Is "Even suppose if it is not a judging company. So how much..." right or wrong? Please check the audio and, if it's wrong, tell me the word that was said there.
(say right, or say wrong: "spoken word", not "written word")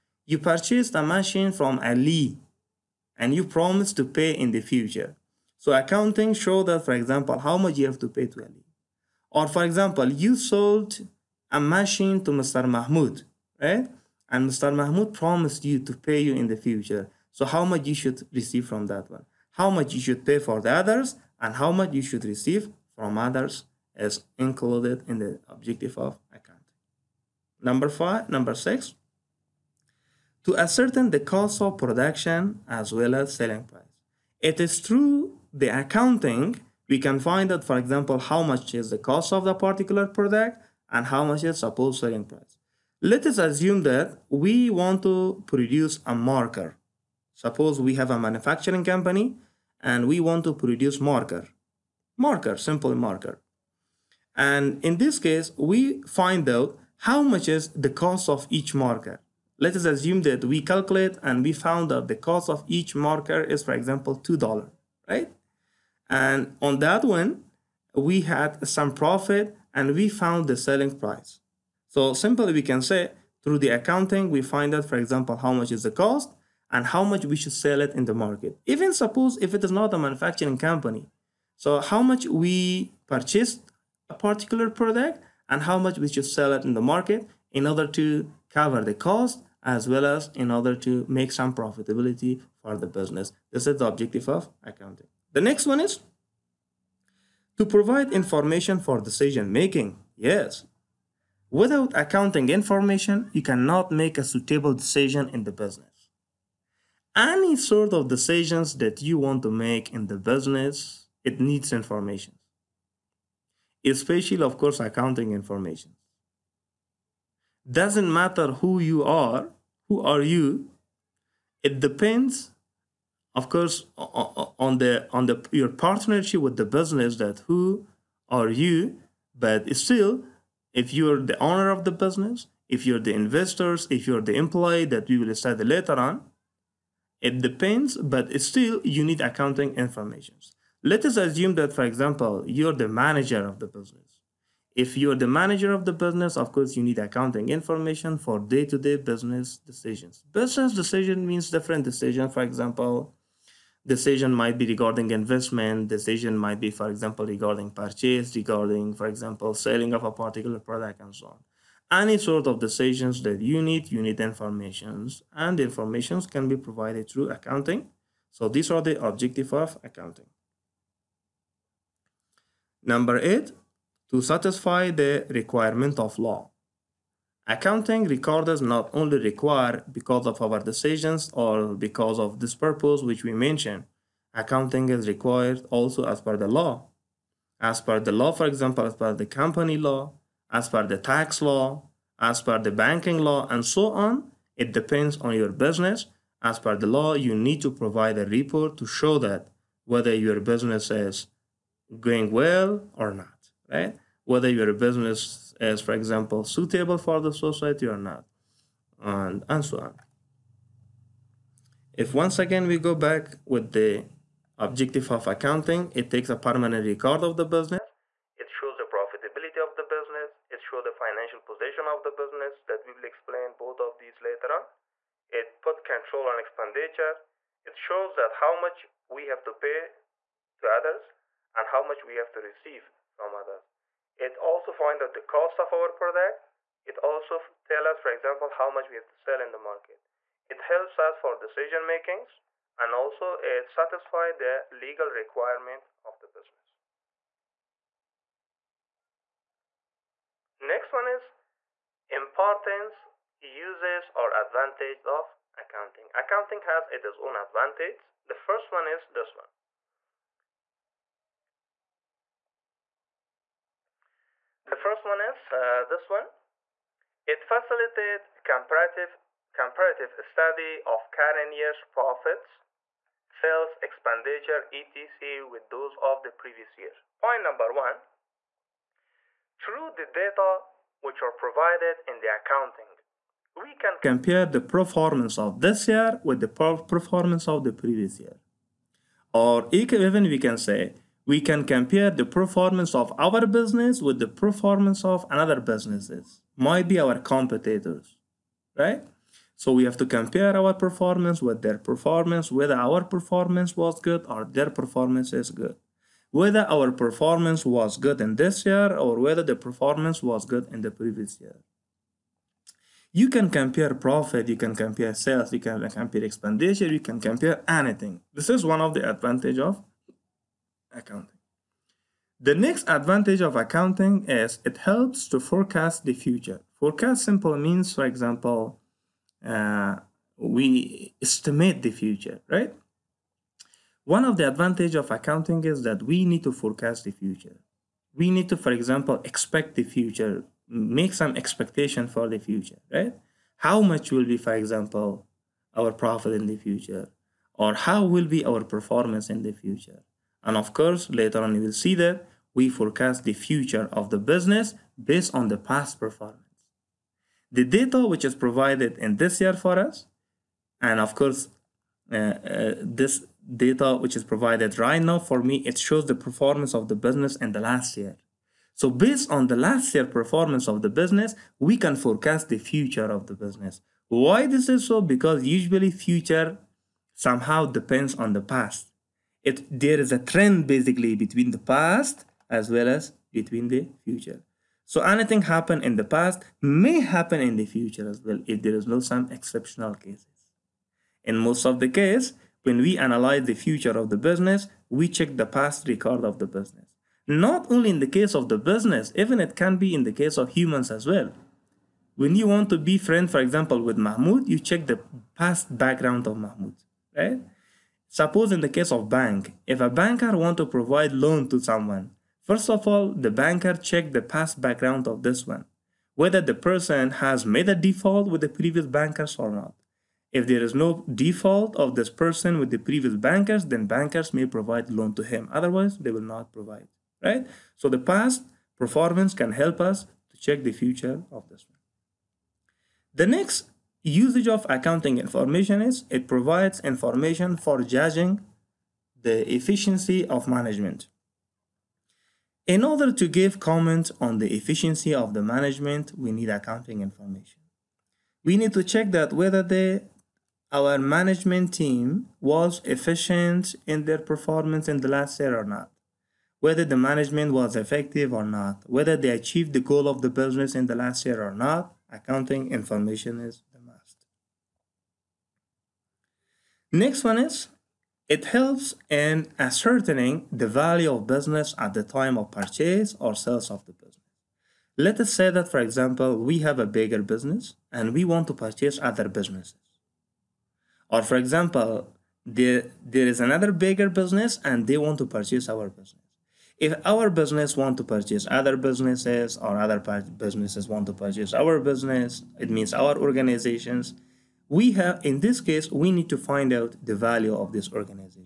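wrong: "manufacturing", not "judging".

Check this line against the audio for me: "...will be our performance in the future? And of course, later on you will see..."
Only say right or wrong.
right.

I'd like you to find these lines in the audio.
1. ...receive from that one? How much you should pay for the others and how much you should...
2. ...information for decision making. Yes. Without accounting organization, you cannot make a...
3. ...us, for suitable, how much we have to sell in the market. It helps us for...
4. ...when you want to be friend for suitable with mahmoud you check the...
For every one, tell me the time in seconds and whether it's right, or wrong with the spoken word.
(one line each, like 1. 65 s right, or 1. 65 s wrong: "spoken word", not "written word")
1. 18 s right
2. 98 s wrong: "information", not "organization"
3. 237 s wrong: "example", not "suitable"
4. 402 s wrong: "example", not "suitable".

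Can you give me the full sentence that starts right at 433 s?
The next Usage of accounting information is it provides information for judging the efficiency of management.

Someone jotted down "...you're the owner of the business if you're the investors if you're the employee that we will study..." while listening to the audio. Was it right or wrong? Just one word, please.
right.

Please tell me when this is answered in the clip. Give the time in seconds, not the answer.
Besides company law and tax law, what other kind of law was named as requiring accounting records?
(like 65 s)
192 s.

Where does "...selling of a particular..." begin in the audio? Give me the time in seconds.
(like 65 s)
159 s.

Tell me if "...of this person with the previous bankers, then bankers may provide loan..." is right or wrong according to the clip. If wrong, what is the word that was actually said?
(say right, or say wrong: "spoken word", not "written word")
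right.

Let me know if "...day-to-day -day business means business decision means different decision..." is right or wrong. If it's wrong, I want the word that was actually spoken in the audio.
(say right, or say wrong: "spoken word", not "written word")
wrong: "decisions", not "means".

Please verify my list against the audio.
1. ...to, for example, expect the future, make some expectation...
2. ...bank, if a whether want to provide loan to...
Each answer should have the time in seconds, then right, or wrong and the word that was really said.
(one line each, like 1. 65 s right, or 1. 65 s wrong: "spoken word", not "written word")
1. 338 s right
2. 409 s wrong: "banker", not "whether".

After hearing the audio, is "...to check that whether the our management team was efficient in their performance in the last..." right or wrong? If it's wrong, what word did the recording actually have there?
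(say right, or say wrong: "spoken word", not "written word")
right.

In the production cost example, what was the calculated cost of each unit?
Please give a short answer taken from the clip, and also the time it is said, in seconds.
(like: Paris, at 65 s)
$2, at 64 s.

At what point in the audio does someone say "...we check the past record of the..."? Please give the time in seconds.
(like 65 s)
394 s.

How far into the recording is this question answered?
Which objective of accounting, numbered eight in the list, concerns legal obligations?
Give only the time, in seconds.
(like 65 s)
174 s.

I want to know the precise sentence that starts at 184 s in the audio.
Accounting is required also as per the law.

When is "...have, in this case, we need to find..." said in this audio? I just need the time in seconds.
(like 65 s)
494 s.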